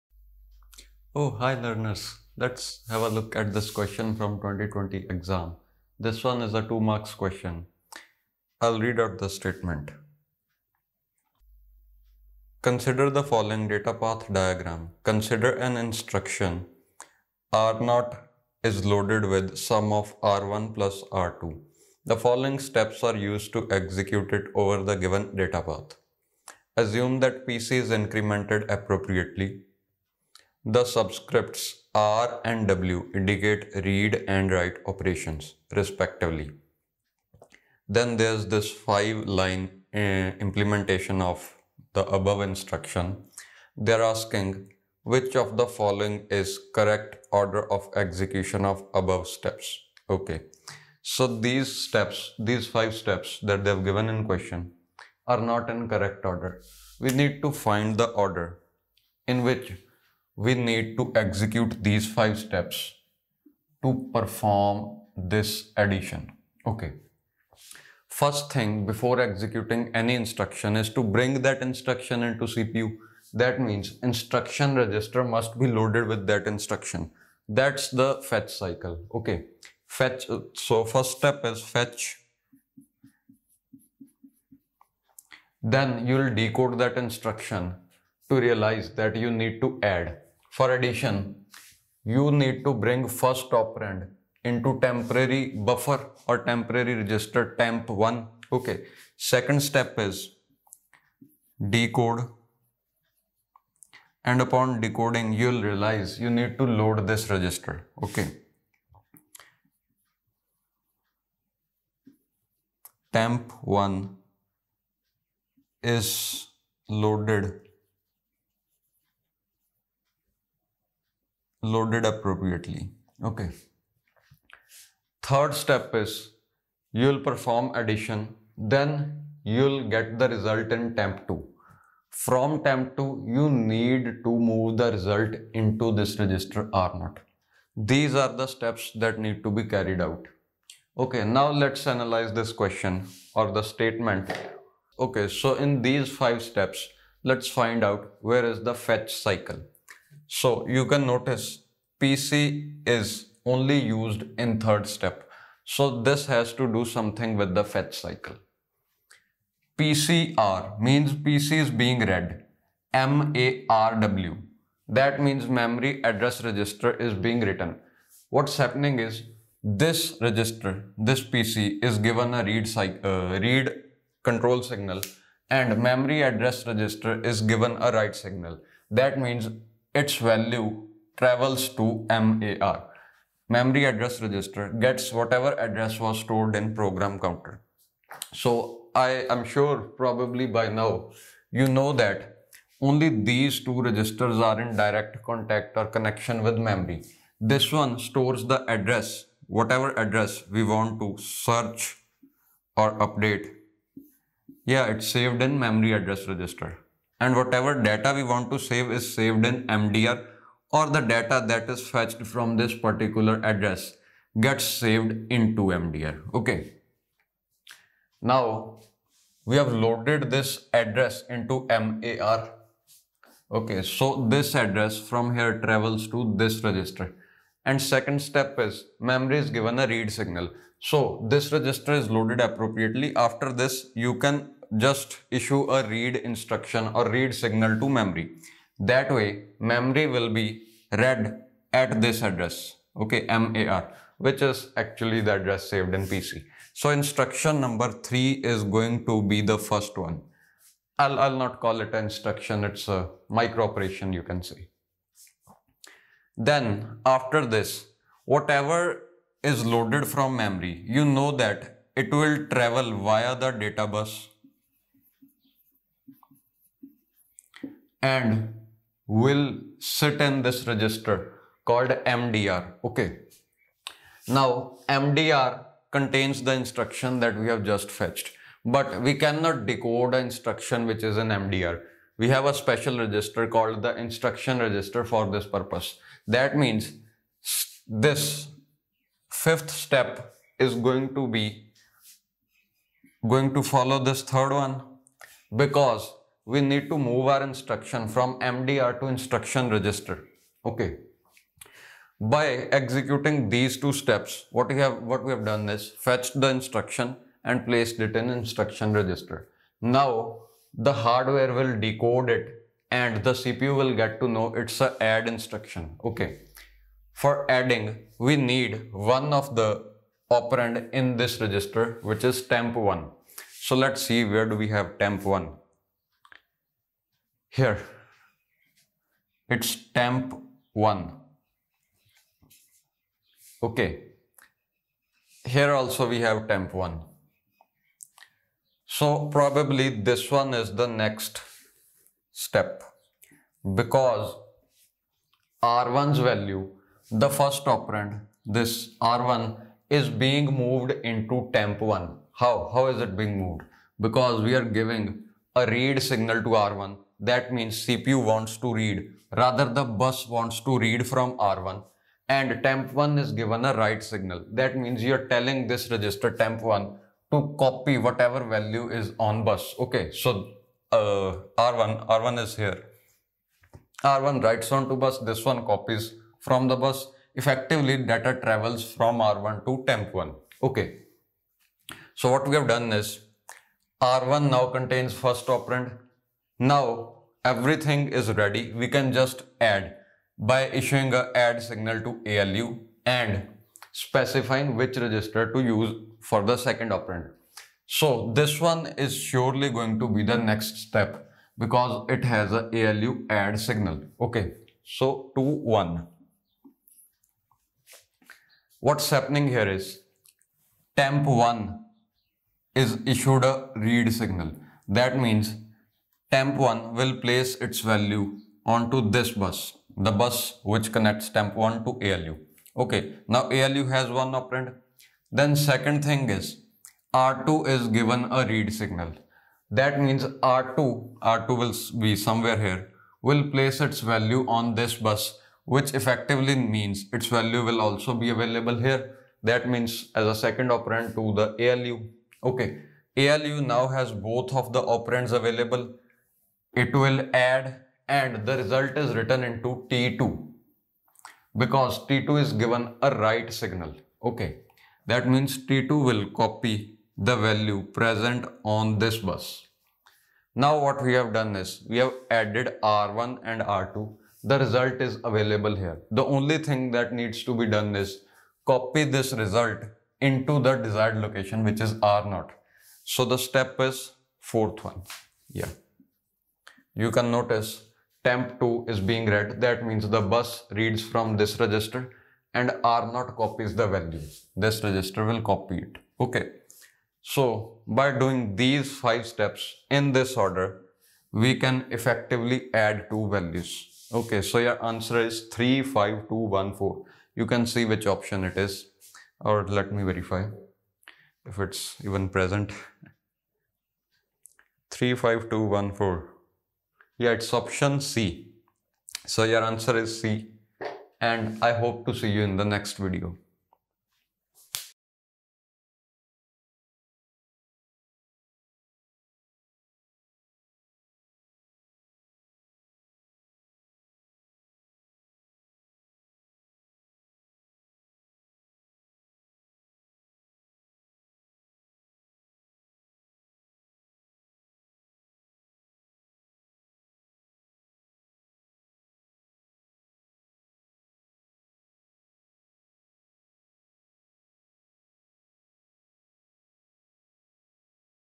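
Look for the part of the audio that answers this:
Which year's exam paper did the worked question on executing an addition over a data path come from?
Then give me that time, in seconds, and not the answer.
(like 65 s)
4 s.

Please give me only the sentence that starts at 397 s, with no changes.
So this one is surely going to be the next step because it has a ALU add signal.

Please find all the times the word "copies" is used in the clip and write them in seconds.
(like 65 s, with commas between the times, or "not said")
375 s, 483 s.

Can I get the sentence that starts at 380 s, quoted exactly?
Okay, so what we have done is R1 now contains first operand, now everything is ready.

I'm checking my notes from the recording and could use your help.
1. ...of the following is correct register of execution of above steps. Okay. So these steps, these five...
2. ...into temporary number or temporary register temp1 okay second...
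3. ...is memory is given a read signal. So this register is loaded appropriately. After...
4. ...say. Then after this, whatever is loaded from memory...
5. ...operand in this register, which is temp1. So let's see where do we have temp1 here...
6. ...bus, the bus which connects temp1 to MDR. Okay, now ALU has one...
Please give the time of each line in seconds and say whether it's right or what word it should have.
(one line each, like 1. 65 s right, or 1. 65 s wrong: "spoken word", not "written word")
1. 45 s wrong: "order", not "register"
2. 94 s wrong: "buffer", not "number"
3. 228 s right
4. 254 s right
5. 320 s right
6. 419 s wrong: "ALU", not "MDR".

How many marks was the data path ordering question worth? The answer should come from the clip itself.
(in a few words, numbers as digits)
2.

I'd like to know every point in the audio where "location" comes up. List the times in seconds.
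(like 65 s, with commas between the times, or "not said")
471 s.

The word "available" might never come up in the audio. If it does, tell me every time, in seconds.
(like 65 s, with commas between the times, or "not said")
438 s, 445 s, 465 s.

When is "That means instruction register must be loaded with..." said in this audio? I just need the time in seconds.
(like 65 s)
73 s.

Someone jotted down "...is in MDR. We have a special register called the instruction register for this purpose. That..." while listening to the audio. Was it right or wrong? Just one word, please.
right.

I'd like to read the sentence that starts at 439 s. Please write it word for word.
That means as a second operand to the ALU.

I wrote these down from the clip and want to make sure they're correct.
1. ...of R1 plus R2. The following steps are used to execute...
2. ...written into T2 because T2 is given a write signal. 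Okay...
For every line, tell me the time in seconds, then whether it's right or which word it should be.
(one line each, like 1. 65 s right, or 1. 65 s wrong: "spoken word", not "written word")
1. 19 s right
2. 449 s right.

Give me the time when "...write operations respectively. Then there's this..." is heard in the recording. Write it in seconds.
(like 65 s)
34 s.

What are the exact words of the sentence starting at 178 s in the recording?
That means its value travels to MAR.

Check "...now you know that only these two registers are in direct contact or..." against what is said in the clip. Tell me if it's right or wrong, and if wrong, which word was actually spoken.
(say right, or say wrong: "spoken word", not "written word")
right.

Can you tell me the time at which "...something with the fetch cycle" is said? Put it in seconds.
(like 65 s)
156 s.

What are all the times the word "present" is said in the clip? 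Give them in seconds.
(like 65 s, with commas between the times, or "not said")
457 s, 502 s.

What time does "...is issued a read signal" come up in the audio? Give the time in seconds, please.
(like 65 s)
412 s.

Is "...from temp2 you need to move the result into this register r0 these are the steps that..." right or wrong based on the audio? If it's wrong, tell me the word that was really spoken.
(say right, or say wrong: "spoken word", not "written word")
right.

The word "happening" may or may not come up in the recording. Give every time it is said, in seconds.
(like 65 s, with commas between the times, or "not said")
168 s, 409 s.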